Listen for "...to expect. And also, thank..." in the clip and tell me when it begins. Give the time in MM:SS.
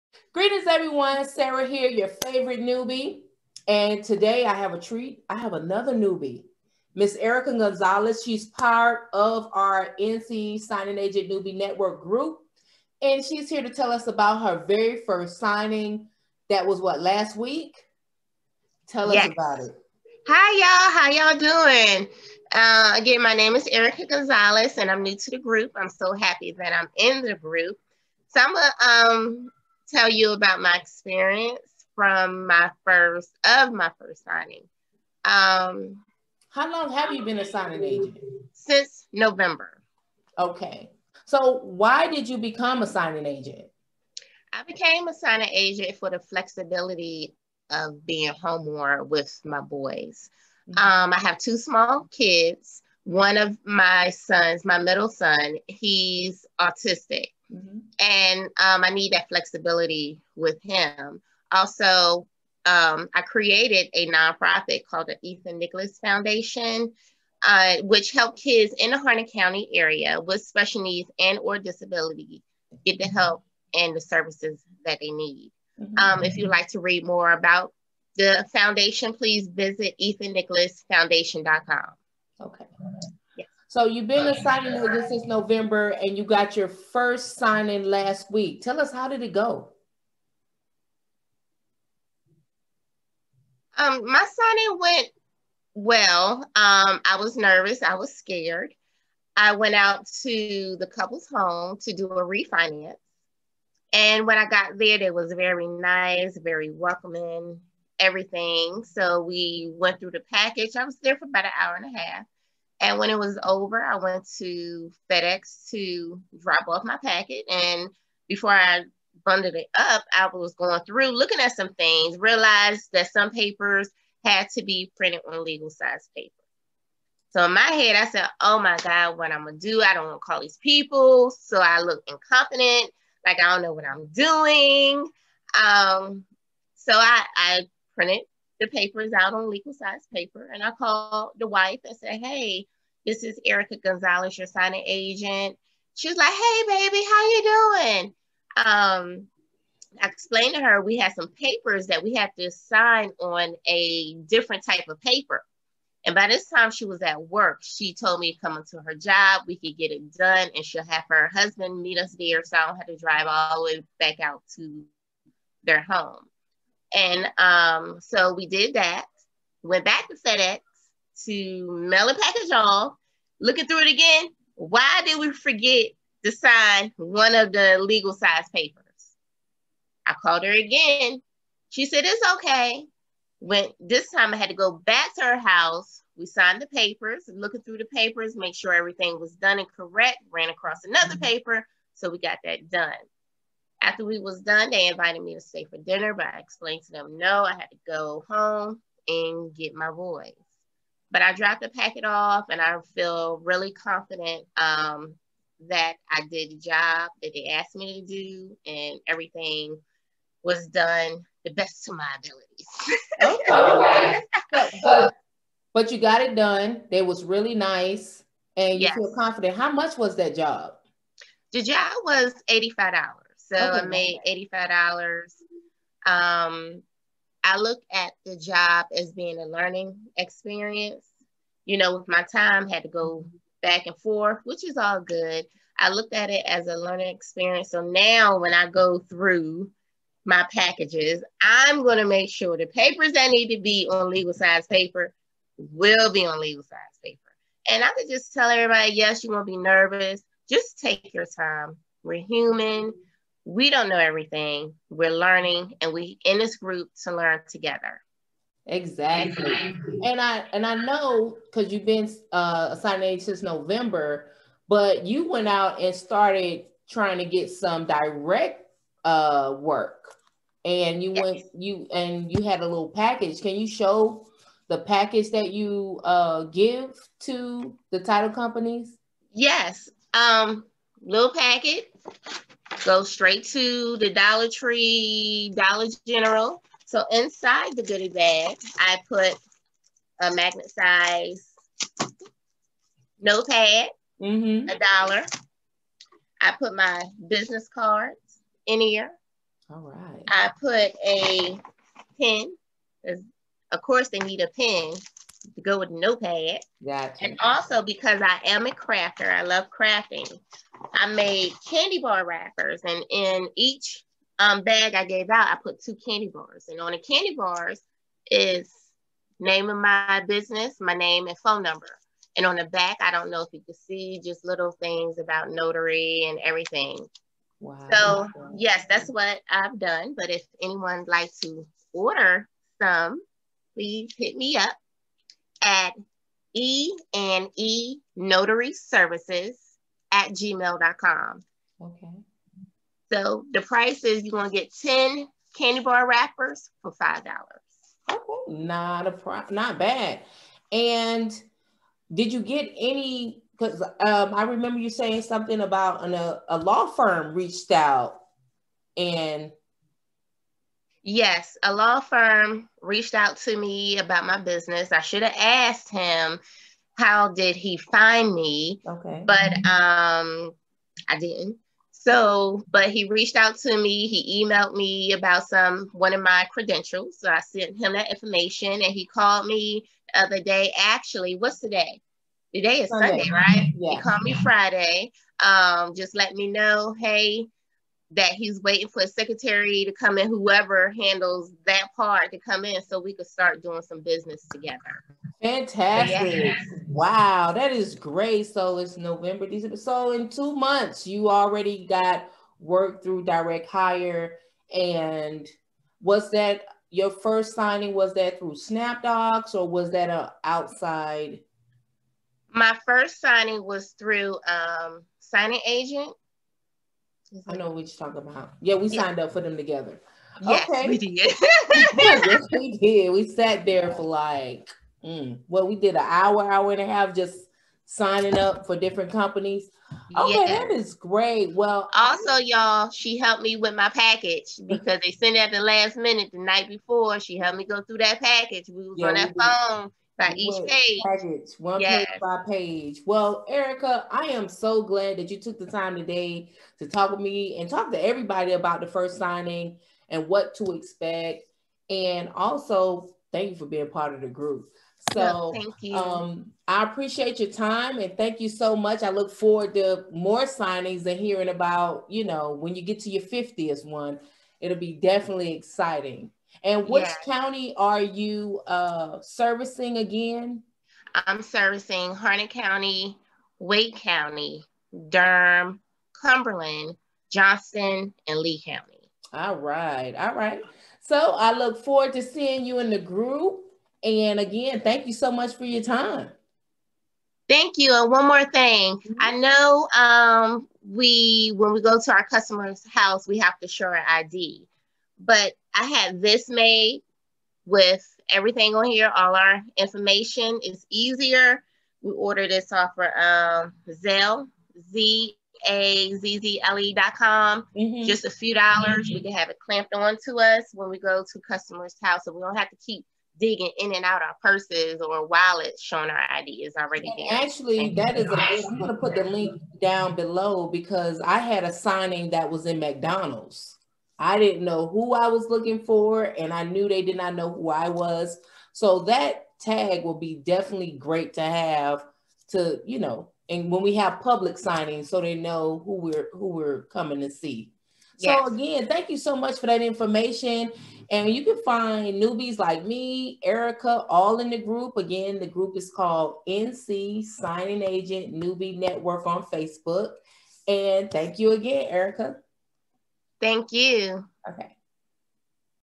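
07:30.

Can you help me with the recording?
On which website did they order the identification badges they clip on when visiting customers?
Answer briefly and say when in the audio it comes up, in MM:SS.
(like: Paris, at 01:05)
Zazzle, at 08:23.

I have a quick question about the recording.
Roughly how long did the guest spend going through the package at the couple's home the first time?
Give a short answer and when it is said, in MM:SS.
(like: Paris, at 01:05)
An hour and a half, at 01:51.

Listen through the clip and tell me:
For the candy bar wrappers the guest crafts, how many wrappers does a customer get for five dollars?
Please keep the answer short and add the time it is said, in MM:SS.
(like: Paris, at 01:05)
10, at 05:44.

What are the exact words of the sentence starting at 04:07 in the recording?
And I could just tell everybody, yes, you won't be nervous.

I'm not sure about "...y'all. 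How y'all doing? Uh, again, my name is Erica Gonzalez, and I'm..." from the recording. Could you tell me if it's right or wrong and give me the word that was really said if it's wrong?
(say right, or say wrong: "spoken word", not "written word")
right.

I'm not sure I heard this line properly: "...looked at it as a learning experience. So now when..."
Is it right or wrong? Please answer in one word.
right.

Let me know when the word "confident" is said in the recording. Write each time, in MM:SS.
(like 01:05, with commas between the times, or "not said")
03:23, 03:39.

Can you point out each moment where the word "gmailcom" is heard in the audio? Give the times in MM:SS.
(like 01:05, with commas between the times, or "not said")
05:40.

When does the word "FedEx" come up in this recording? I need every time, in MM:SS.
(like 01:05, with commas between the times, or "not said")
01:55, 02:50.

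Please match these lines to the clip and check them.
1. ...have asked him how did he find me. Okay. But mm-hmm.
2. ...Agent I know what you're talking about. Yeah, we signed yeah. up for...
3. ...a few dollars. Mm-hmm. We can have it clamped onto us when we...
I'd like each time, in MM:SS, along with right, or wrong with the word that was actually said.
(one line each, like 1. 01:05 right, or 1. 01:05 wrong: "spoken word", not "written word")
1. 06:05 right
2. 06:55 right
3. 08:28 right.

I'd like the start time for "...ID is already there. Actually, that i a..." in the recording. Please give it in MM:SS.
08:36.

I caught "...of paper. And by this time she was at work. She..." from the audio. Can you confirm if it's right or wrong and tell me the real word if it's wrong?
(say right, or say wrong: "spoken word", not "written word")
right.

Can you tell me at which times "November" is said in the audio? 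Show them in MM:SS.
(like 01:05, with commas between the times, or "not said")
00:39, 01:25, 04:23, 06:38.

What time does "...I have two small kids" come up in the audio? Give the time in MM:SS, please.
00:51.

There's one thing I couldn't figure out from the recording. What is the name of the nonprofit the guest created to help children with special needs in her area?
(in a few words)
Ethan Nicholas Foundation.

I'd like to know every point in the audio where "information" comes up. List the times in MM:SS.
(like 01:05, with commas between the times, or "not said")
06:18, 08:19, 08:59.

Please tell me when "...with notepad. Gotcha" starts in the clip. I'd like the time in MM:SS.
05:05.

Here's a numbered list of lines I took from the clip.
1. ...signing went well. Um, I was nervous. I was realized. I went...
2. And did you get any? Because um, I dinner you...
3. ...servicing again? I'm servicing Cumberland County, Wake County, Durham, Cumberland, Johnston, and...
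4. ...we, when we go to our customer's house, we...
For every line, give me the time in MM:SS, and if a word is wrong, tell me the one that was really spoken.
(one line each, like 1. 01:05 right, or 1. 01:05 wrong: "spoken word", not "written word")
1. 01:34 wrong: "scared", not "realized"
2. 05:50 wrong: "remember", not "dinner"
3. 07:49 wrong: "Harnett", not "Cumberland"
4. 08:10 right.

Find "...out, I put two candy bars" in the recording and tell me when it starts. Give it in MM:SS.
05:15.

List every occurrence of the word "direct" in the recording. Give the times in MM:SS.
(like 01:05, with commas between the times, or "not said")
04:27, 06:43.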